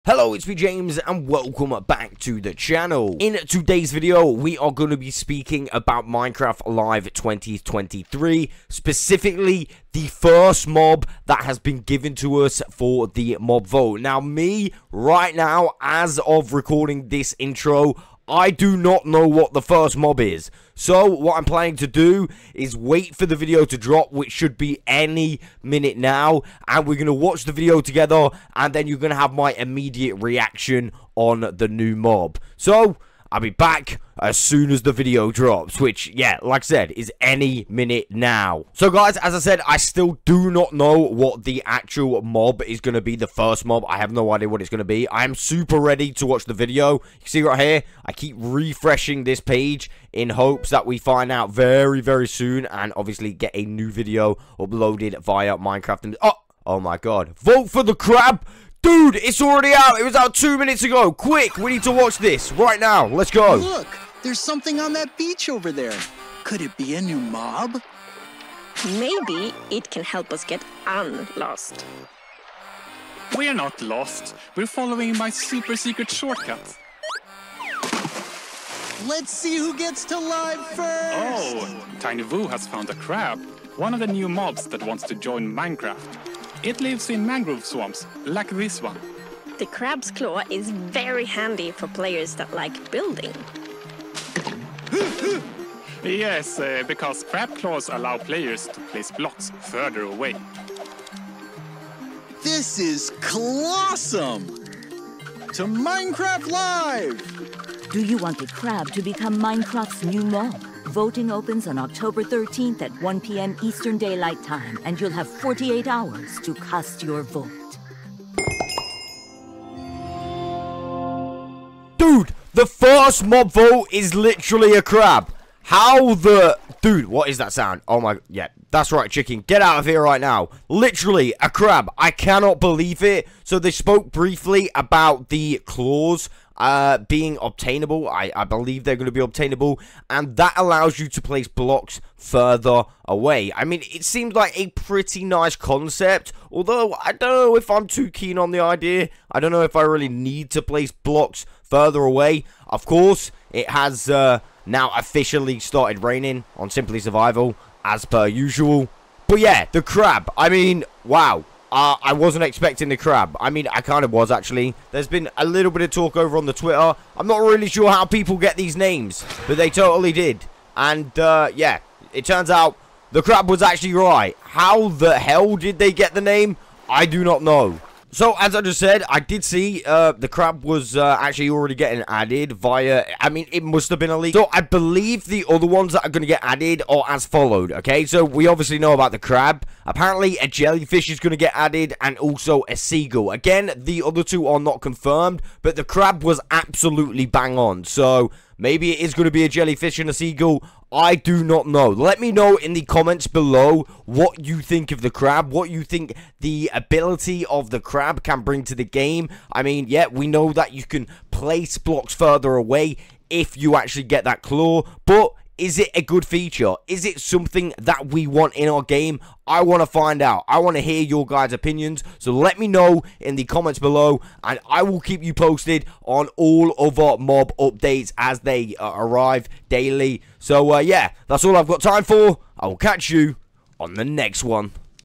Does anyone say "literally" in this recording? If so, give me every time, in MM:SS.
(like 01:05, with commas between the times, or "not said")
02:04, 02:10.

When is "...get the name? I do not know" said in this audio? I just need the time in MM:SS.
02:55.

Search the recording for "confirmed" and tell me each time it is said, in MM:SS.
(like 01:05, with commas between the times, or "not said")
03:14.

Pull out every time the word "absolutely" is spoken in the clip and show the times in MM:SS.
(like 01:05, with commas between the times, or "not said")
03:16.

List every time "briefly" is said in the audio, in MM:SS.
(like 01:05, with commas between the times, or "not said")
02:14.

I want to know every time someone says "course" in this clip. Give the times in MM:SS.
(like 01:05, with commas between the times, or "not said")
02:32.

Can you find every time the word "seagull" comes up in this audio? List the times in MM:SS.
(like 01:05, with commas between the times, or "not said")
03:12, 03:20.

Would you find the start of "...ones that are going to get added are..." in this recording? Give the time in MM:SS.
03:05.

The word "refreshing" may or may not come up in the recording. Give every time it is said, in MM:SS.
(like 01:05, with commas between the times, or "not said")
00:48.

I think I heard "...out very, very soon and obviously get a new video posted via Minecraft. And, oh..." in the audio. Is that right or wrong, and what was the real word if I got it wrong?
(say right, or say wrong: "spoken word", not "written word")
wrong: "uploaded", not "posted".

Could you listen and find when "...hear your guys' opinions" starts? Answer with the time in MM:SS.
03:40.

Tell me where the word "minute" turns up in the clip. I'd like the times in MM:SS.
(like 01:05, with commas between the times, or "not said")
00:25, 00:37, 01:00.